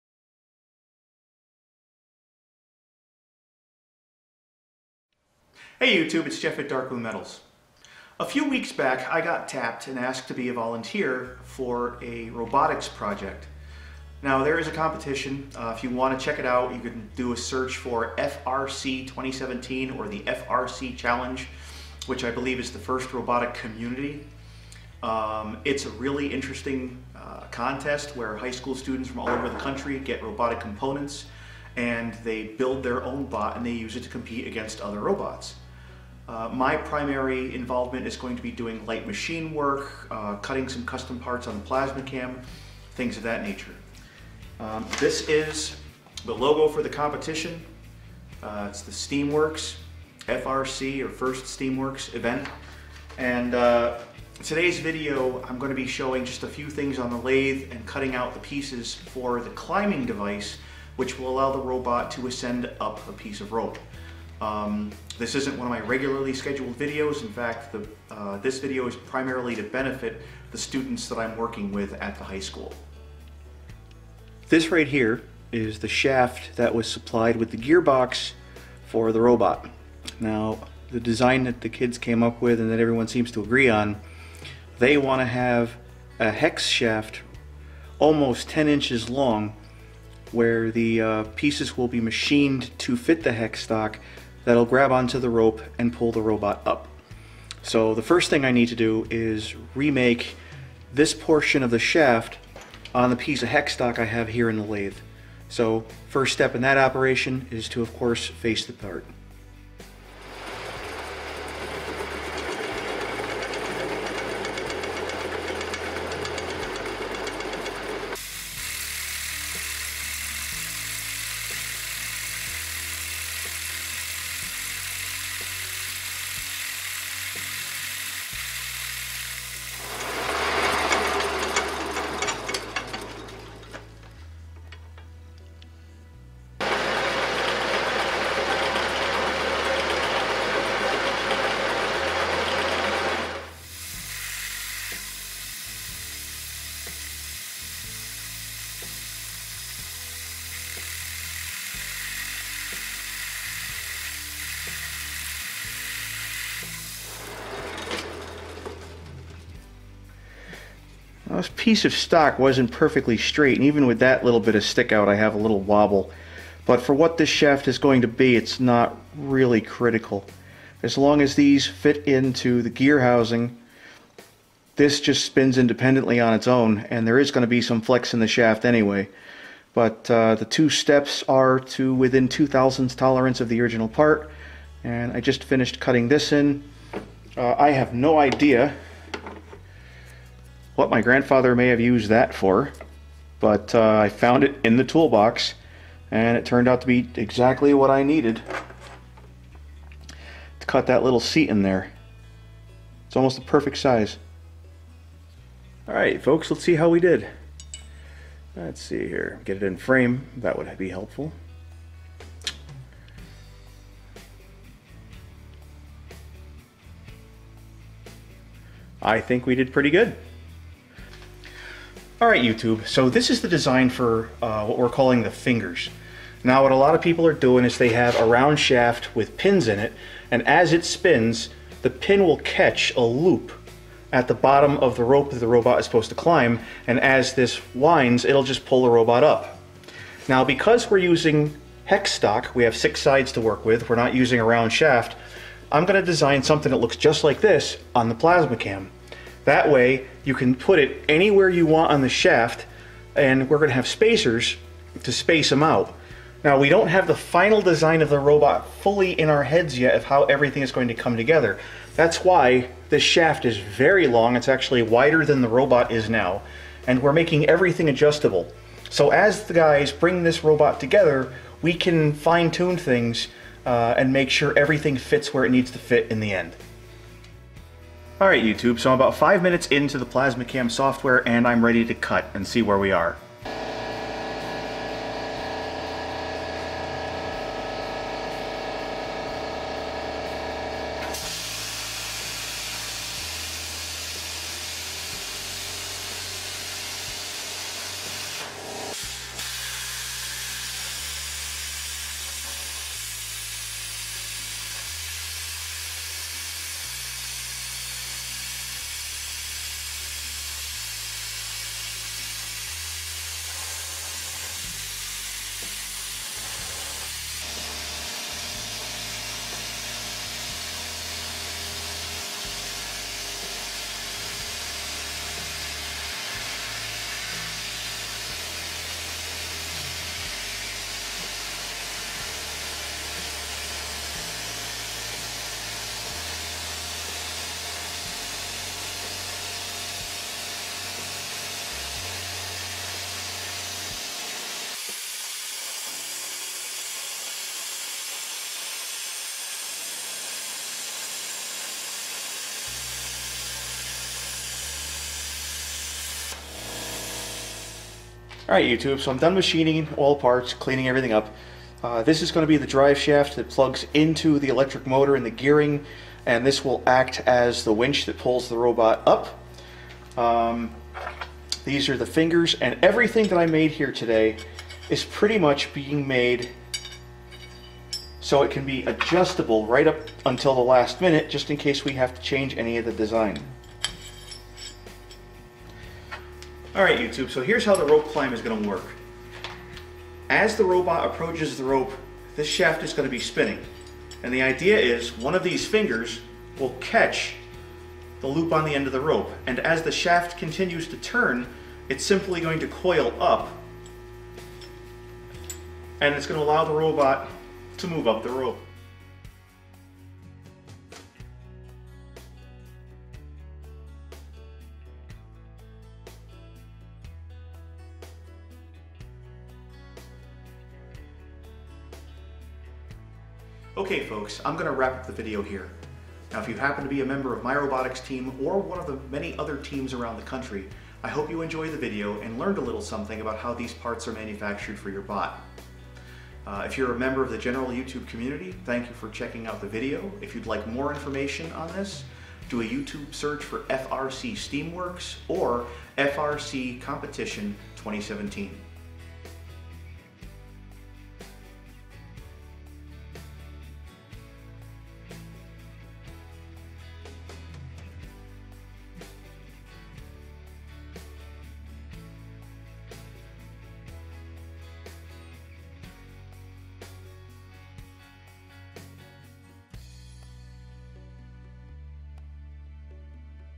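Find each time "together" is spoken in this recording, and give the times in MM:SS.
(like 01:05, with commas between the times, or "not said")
04:21, 04:30.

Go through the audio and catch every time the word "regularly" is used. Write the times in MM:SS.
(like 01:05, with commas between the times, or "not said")
01:05.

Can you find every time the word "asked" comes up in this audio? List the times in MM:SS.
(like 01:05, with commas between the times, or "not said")
00:09.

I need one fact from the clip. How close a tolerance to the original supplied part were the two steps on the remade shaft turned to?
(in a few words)
2 thousandths.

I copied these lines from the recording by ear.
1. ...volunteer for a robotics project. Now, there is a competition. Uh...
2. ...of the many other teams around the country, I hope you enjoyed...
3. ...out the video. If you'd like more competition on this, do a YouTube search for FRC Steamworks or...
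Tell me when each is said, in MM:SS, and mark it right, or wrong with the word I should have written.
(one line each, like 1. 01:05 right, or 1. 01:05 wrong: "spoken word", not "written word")
1. 00:10 right
2. 07:08 right
3. 07:19 wrong: "information", not "competition".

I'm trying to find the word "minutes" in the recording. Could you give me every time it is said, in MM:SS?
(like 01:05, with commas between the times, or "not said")
04:39, 06:20.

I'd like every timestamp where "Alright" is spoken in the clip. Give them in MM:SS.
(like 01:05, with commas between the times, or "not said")
03:25, 03:42, 04:38, 05:58.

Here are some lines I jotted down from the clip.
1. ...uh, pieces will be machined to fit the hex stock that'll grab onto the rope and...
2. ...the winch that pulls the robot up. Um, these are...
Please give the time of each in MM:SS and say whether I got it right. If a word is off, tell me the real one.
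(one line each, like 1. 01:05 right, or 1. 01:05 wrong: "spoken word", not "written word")
1. 01:30 right
2. 06:07 right.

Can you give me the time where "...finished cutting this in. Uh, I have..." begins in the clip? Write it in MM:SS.
03:05.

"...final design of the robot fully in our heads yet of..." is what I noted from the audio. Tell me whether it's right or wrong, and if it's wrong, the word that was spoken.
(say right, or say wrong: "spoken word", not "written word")
right.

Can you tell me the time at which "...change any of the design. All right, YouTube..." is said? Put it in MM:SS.
06:22.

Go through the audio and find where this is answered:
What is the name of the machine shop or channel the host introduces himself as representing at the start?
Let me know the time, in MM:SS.
00:06.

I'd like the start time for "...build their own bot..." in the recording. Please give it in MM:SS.
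00:32.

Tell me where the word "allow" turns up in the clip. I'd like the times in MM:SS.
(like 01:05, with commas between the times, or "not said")
01:01, 06:46.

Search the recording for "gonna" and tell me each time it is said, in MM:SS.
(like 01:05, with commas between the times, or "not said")
04:13, 06:28, 06:32, 06:46.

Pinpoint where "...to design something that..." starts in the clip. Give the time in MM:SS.
04:05.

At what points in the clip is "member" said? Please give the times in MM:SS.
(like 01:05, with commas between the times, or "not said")
07:07, 07:16.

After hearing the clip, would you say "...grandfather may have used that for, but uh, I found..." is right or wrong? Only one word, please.
right.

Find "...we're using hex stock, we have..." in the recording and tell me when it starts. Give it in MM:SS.
04:00.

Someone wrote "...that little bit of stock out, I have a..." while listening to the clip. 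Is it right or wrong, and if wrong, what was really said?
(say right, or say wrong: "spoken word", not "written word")
wrong: "stick", not "stock".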